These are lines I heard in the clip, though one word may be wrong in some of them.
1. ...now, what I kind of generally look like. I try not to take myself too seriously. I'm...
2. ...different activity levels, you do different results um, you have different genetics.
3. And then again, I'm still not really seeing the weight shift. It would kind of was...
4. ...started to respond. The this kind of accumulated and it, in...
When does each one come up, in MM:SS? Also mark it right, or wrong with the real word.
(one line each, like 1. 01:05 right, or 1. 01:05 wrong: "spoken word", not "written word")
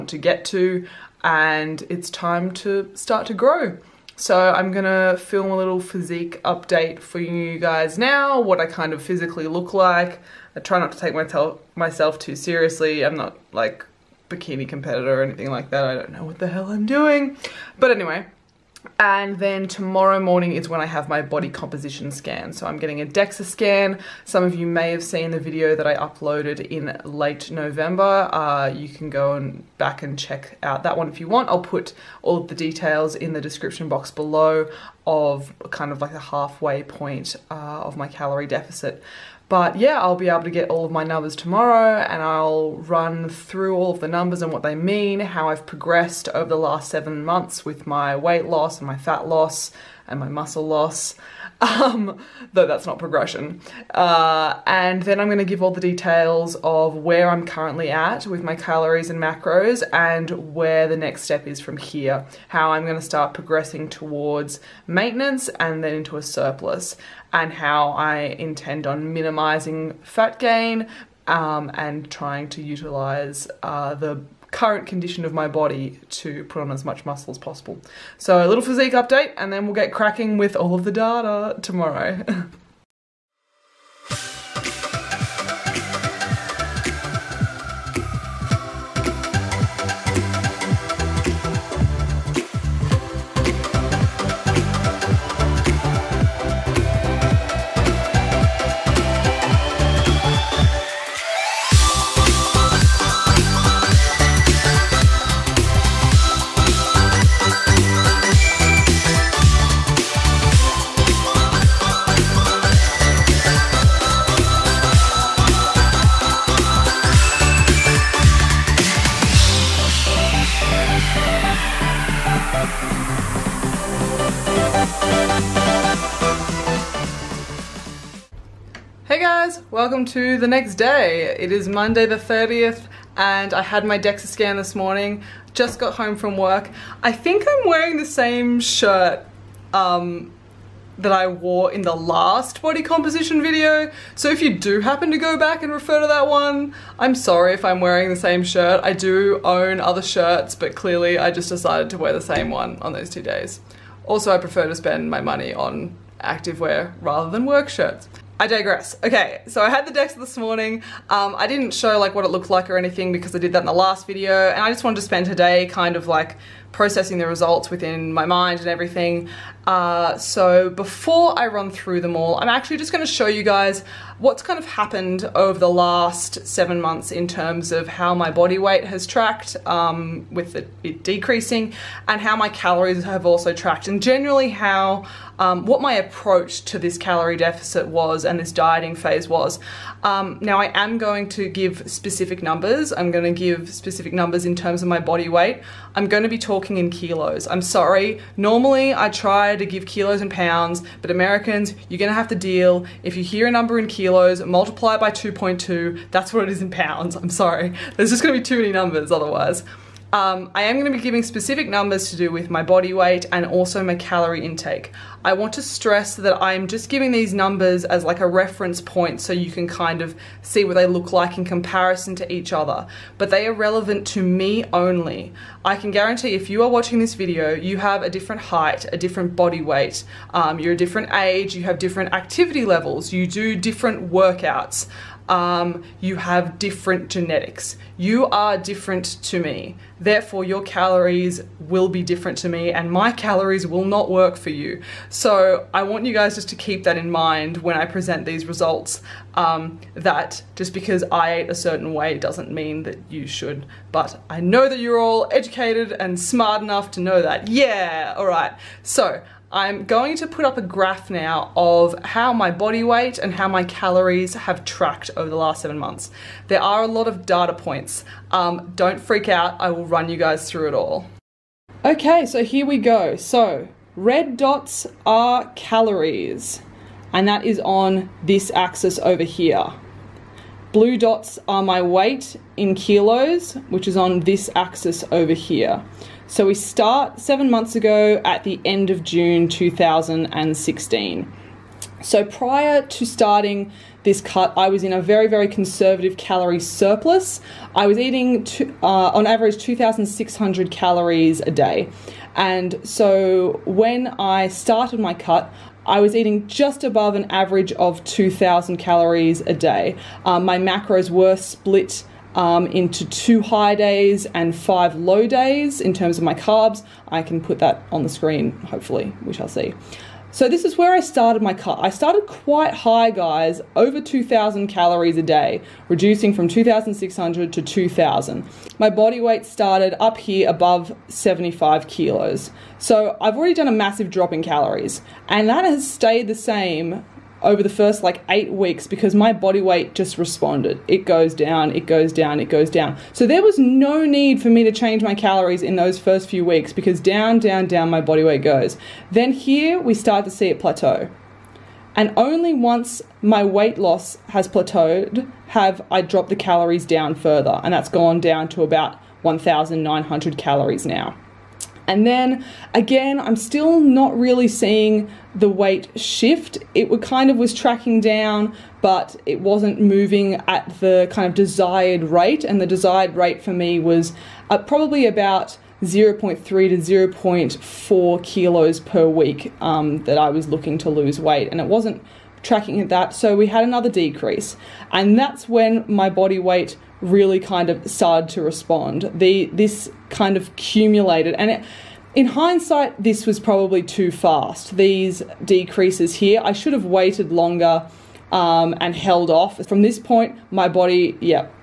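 1. 00:07 wrong: "physically", not "generally"
2. 03:51 wrong: "workouts", not "results"
3. 06:01 right
4. 06:27 right.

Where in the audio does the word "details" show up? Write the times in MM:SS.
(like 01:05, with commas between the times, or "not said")
00:32, 00:55.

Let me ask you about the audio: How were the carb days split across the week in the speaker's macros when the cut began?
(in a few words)
two high days and five low days.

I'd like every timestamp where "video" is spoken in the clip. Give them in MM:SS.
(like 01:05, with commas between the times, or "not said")
00:25, 02:23, 02:44, 03:47.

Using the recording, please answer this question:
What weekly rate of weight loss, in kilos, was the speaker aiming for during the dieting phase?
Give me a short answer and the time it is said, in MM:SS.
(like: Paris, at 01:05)
0.3 to 0.4 kilos, at 06:15.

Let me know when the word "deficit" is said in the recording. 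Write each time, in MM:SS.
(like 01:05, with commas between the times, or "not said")
00:38, 03:07.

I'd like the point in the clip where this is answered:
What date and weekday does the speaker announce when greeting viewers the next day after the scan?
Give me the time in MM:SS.
02:11.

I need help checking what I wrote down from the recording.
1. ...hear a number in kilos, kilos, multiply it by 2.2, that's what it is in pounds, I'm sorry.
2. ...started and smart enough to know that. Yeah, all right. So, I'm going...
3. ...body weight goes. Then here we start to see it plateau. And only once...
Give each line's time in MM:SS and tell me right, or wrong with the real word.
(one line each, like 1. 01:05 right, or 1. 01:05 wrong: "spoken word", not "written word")
1. 03:23 right
2. 04:15 wrong: "educated", not "started"
3. 05:48 right.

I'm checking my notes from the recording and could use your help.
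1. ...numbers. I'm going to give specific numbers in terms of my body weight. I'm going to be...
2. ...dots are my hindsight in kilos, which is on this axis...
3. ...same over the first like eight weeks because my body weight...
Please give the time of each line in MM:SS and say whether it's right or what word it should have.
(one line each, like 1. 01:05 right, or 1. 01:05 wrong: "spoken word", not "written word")
1. 03:12 right
2. 04:40 wrong: "weight", not "hindsight"
3. 05:36 right.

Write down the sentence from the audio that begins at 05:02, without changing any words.
And so when I started my cut, I was eating just above an average of 2,000 calories a day.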